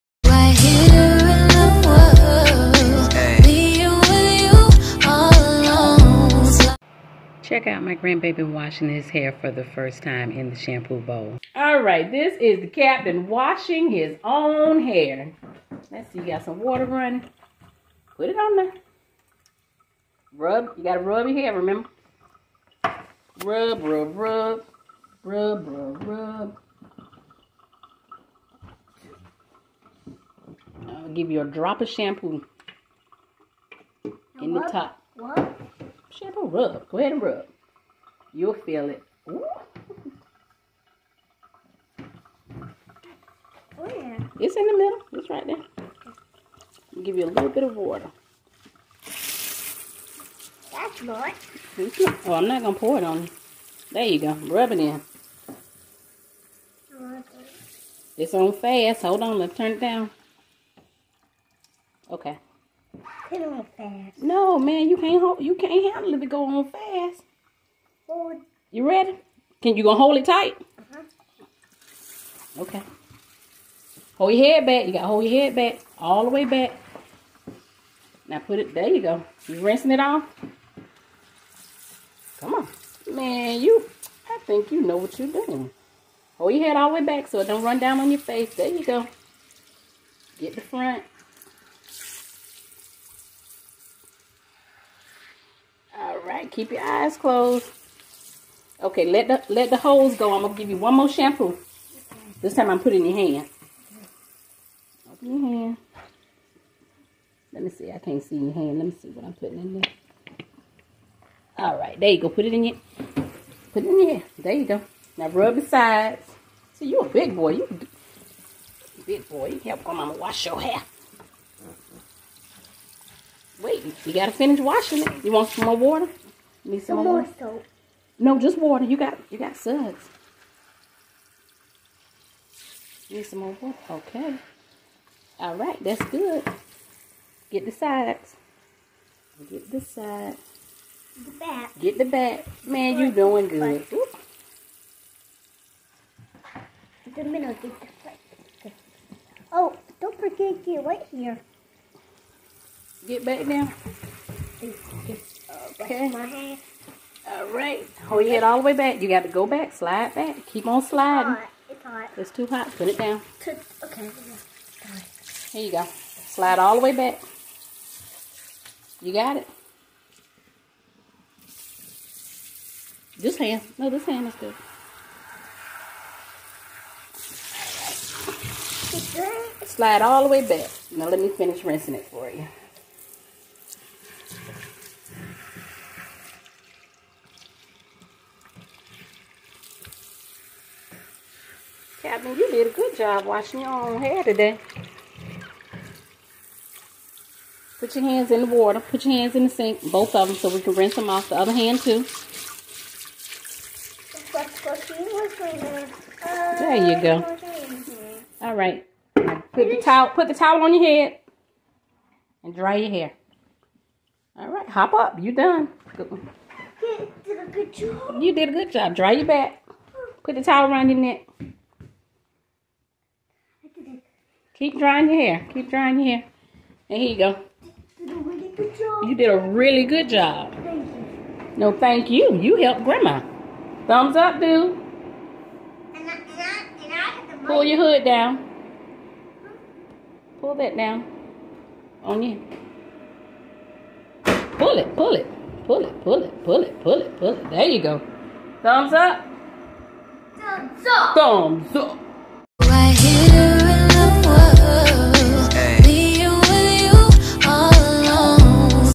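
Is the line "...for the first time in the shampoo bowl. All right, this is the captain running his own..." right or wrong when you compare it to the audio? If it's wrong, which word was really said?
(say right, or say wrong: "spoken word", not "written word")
wrong: "washing", not "running".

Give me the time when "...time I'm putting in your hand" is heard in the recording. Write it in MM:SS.
01:42.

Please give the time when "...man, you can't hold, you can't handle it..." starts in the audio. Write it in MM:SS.
01:04.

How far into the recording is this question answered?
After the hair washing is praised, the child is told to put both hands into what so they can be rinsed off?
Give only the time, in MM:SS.
03:19.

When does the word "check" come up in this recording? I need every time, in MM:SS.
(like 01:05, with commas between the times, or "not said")
00:07.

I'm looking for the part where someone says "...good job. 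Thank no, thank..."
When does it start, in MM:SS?
03:49.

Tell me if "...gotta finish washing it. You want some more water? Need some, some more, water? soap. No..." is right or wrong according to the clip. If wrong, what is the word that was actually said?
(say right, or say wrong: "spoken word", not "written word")
right.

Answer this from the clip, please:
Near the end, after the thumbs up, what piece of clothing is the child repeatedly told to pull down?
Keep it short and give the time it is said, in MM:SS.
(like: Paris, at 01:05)
hood, at 03:57.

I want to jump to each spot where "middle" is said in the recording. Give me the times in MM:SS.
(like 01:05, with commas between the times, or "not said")
00:44, 02:27.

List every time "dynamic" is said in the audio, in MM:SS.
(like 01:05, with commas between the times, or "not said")
not said.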